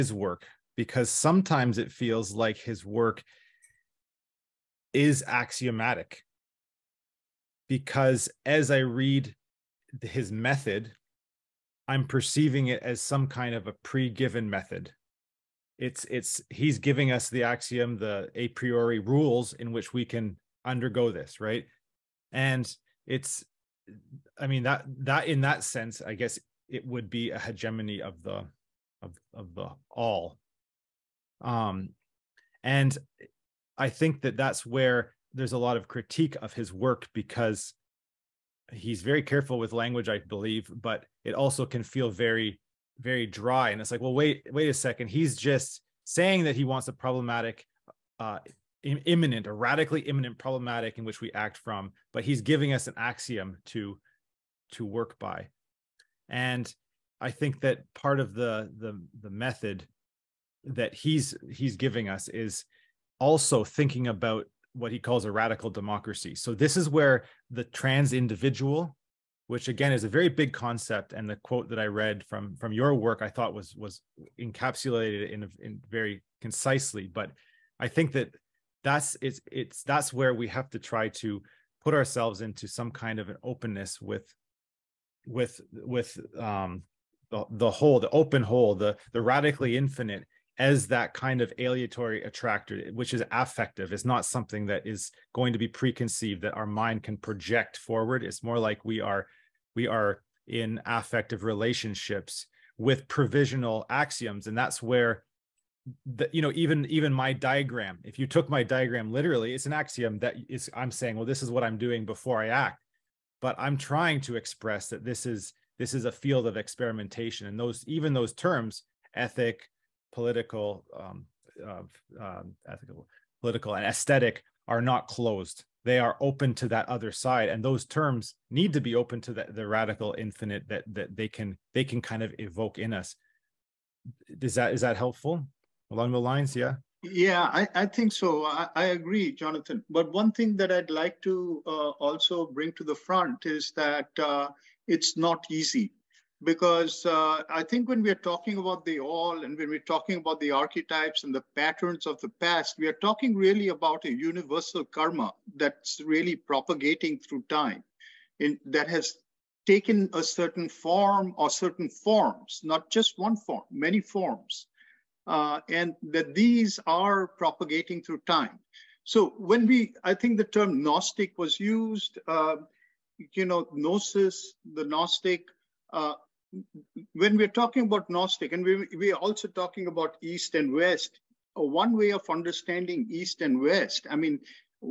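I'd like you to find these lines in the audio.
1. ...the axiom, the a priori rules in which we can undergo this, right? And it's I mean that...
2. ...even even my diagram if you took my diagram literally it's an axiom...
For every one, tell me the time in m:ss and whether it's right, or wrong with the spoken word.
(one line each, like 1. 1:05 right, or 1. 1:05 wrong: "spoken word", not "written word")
1. 0:17 right
2. 1:46 right.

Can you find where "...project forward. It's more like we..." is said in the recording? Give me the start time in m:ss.
1:37.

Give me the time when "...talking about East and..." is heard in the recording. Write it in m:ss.
2:59.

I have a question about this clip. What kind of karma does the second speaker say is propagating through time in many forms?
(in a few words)
Universal karma.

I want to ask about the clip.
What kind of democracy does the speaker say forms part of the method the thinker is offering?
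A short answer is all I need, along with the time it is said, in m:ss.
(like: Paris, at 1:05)
Radical democracy, at 1:05.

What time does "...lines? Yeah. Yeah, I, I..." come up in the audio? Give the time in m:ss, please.
2:16.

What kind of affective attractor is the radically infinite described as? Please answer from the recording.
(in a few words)
Aleatory.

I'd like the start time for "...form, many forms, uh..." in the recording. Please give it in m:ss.
2:43.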